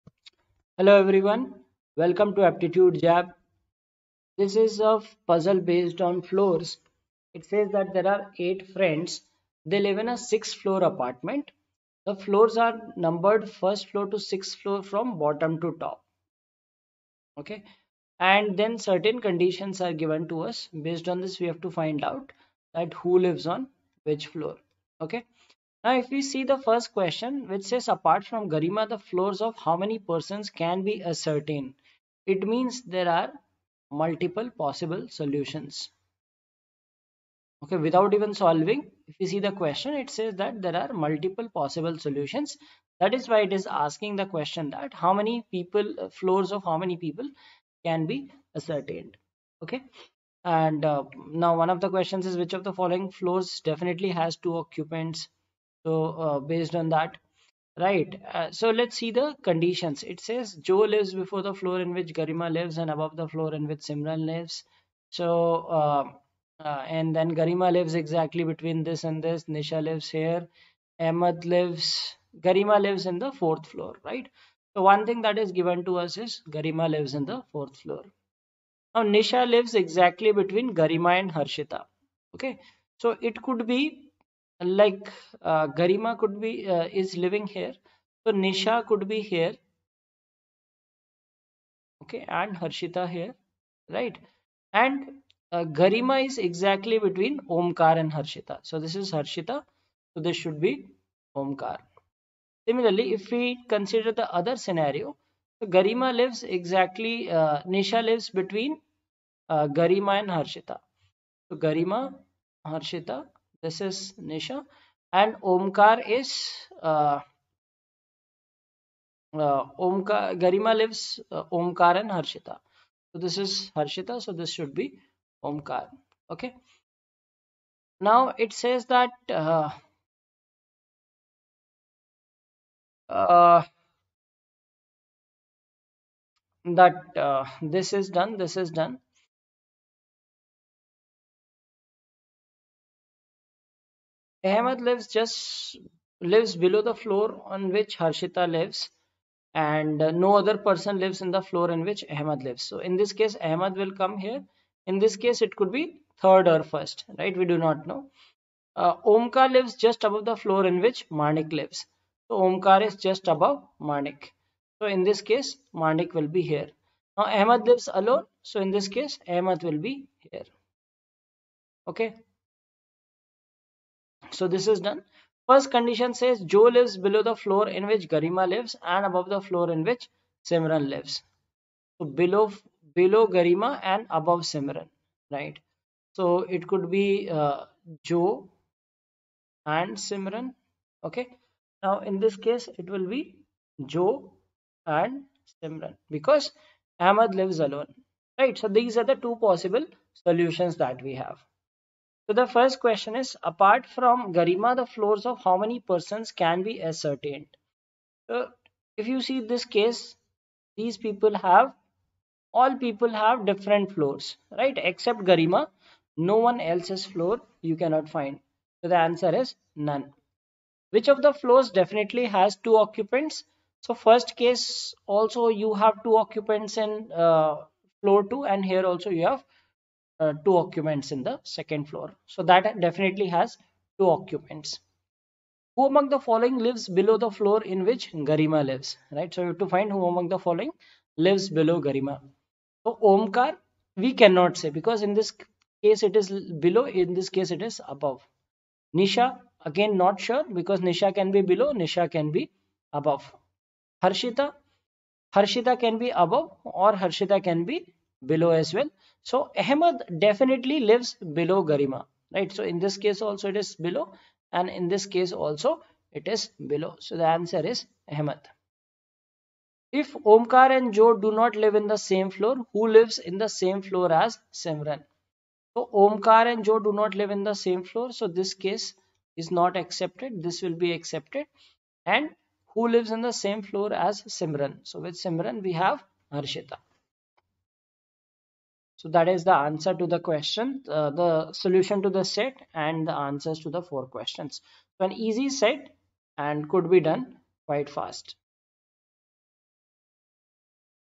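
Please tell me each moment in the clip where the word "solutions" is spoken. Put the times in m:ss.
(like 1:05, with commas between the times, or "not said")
0:35, 0:41, 3:20, 4:51.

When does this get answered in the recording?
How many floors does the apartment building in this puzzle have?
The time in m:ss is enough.
0:10.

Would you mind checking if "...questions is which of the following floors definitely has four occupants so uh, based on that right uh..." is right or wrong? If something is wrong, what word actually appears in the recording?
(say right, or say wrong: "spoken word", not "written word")
wrong: "two", not "four".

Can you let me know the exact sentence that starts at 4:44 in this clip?
So with Simran we have Harshita.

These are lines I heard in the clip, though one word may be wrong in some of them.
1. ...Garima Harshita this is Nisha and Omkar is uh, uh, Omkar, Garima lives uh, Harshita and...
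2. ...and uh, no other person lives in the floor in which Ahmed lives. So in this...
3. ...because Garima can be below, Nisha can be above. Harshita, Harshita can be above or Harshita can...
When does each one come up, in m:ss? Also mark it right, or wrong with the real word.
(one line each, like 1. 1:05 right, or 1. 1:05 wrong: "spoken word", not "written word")
1. 1:51 wrong: "Omkar", not "Harshita"
2. 2:29 right
3. 4:10 wrong: "Nisha", not "Garima".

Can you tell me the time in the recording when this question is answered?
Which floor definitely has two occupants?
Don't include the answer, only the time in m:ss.
3:51.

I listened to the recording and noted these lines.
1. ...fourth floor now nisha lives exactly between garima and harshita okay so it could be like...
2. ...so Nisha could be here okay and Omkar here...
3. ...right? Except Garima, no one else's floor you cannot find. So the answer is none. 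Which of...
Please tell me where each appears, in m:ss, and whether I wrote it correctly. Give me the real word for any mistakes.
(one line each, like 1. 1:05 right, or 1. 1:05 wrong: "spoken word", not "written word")
1. 1:17 right
2. 1:28 wrong: "Harshita", not "Omkar"
3. 3:34 right.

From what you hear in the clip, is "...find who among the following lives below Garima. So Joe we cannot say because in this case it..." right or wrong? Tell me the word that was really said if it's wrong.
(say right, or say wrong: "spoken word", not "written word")
wrong: "Omkar", not "Joe".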